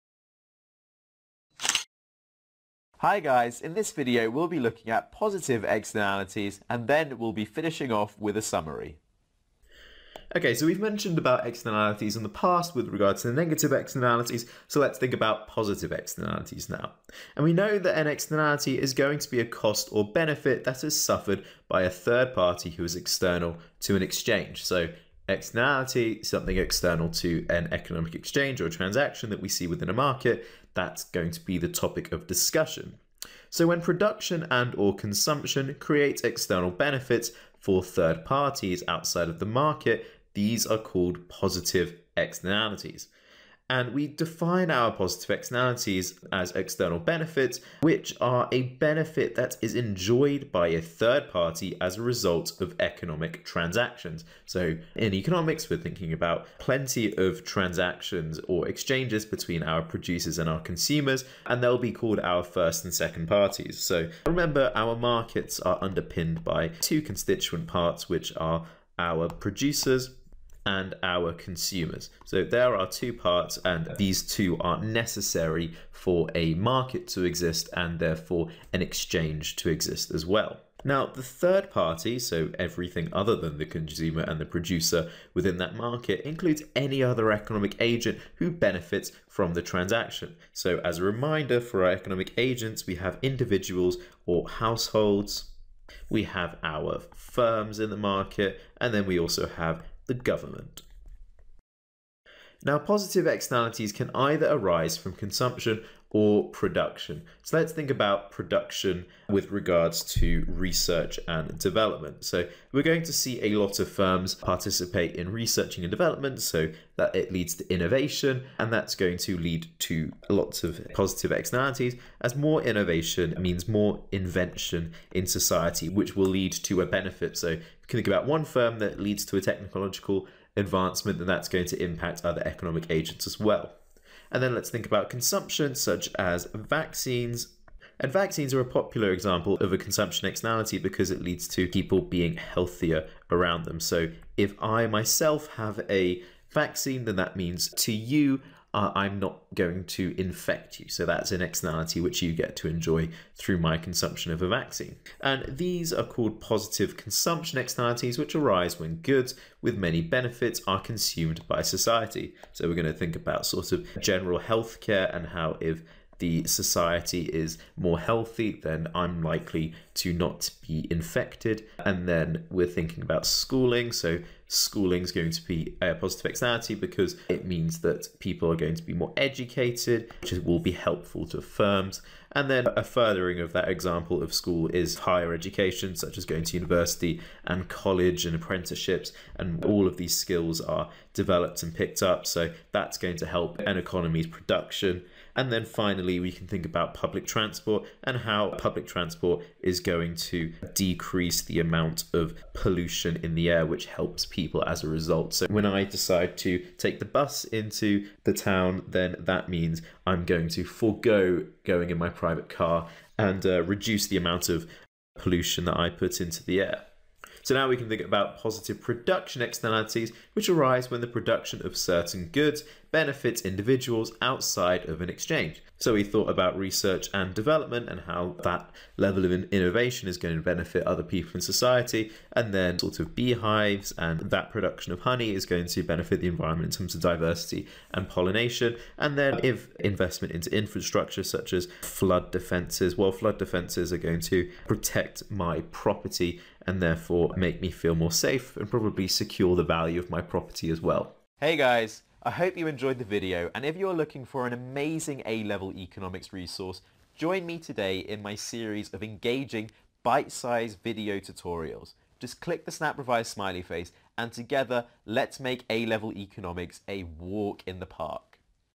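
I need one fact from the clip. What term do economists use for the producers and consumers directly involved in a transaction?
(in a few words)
first and second parties.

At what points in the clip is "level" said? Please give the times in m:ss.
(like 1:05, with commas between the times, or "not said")
3:48, 4:15, 4:25.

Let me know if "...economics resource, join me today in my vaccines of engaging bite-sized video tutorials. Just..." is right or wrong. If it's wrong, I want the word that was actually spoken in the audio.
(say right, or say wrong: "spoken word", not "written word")
wrong: "series", not "vaccines".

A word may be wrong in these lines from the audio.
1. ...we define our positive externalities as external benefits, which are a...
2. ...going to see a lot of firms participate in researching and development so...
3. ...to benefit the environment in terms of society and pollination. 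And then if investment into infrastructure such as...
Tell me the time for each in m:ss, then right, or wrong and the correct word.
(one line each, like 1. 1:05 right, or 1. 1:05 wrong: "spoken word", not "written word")
1. 0:43 right
2. 1:52 right
3. 3:55 wrong: "diversity", not "society".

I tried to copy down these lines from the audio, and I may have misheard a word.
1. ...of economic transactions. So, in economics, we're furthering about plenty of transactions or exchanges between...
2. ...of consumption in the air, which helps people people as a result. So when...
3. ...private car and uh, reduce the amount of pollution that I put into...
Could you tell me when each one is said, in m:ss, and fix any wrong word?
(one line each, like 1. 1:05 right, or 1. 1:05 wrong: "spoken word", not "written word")
1. 0:52 wrong: "thinking", not "furthering"
2. 3:22 wrong: "pollution", not "consumption"
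3. 3:32 right.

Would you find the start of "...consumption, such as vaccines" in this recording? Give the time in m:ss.
2:15.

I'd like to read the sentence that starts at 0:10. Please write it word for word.
Okay, so we've mentioned about externalities in the past with regards to the negative externalities, so let's think about positive externalities now.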